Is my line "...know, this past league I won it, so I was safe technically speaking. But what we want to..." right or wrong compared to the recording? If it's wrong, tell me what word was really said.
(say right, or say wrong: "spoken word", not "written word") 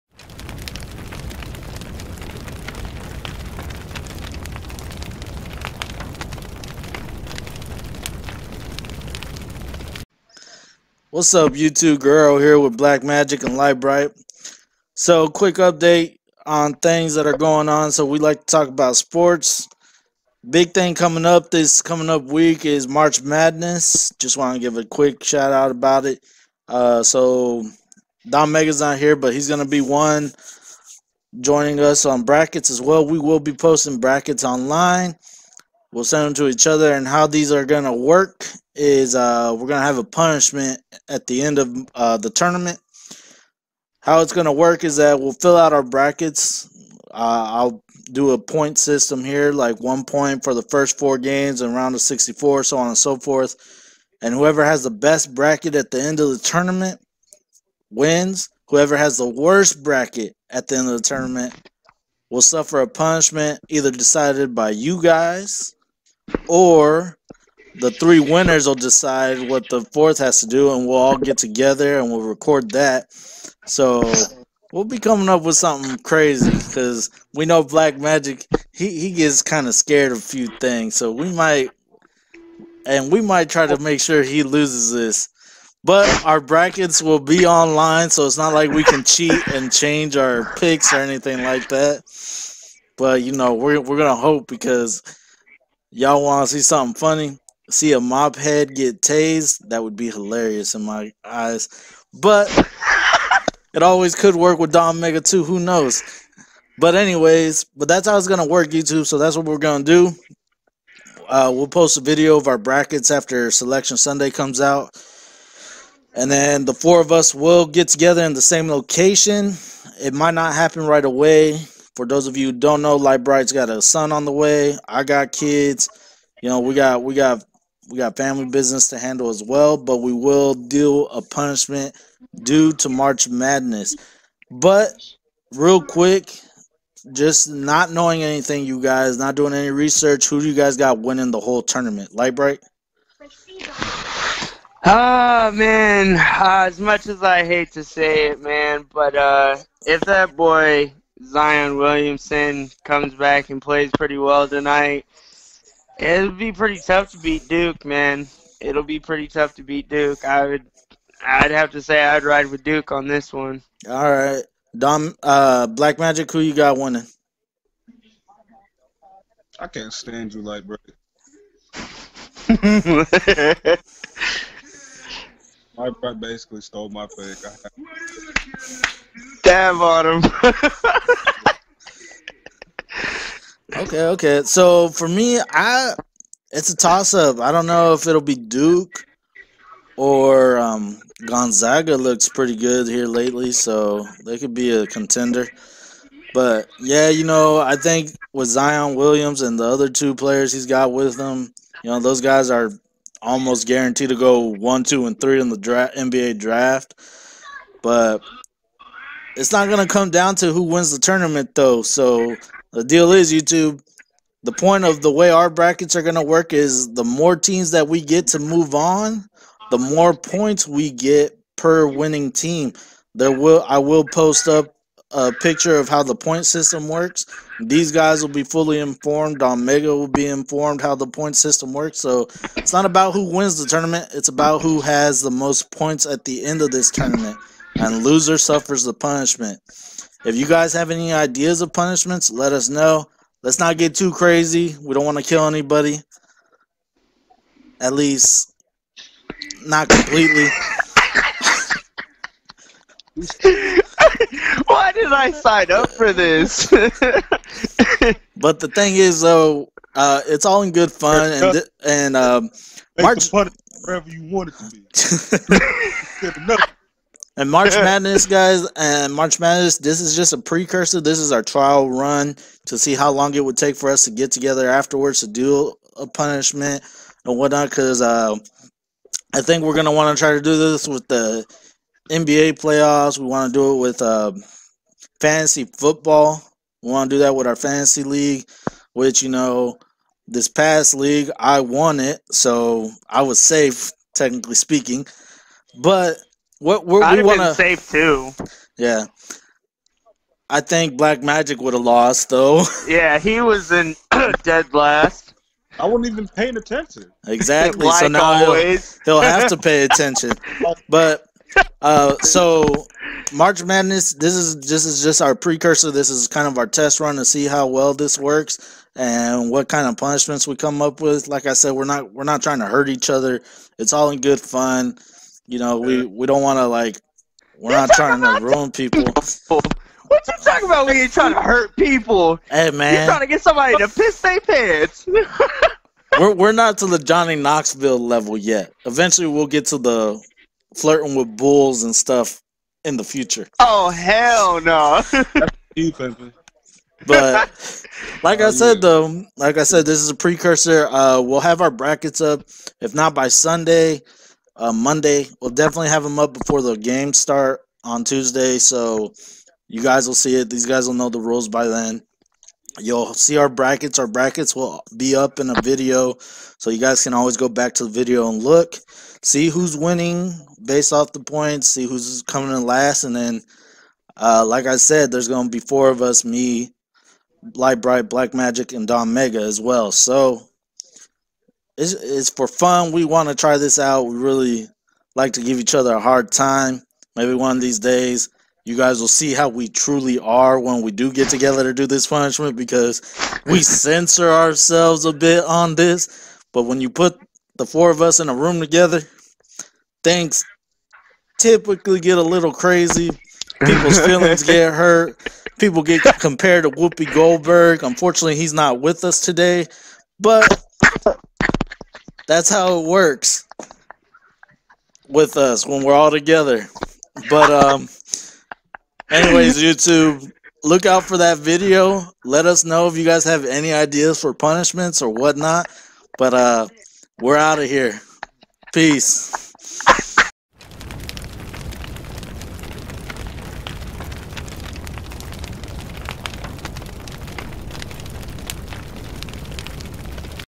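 right.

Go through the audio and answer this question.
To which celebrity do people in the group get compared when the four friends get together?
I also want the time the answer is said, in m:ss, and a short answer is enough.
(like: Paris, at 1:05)
Whoopi Goldberg, at 6:46.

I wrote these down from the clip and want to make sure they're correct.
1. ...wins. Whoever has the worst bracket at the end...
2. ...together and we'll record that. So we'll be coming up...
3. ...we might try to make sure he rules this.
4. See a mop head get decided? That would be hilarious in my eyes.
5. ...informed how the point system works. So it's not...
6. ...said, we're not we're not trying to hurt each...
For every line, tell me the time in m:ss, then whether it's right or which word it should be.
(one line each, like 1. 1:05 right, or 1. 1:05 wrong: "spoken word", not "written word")
1. 0:57 right
2. 1:11 right
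3. 1:23 wrong: "loses", not "rules"
4. 1:37 wrong: "tased", not "decided"
5. 3:50 right
6. 5:21 right.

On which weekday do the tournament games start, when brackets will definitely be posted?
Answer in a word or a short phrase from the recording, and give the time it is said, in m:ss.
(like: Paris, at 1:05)
Tuesday, at 5:58.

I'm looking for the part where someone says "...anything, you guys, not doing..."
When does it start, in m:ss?
2:18.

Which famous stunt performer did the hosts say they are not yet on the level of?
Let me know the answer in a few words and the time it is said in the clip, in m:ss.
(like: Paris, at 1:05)
Johnny Knoxville, at 5:36.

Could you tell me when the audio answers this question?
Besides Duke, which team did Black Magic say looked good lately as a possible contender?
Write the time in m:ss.
3:11.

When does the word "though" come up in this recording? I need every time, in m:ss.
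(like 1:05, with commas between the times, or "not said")
3:31, 4:19, 5:02, 5:48.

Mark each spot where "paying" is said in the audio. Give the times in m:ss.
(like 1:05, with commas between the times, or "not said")
5:06.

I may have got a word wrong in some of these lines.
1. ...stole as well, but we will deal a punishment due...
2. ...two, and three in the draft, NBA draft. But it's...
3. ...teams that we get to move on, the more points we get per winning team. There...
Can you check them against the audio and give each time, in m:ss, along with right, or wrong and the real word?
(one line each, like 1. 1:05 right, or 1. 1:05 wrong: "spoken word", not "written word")
1. 2:08 wrong: "handle", not "stole"
2. 3:24 right
3. 3:37 right.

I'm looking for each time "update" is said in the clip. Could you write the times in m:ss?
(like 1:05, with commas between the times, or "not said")
0:15.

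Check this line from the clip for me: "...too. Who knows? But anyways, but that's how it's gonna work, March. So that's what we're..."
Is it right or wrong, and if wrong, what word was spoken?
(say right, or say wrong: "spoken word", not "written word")
wrong: "YouTube", not "March".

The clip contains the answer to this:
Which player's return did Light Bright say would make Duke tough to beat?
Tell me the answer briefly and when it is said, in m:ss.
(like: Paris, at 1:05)
Zion Williamson, at 2:31.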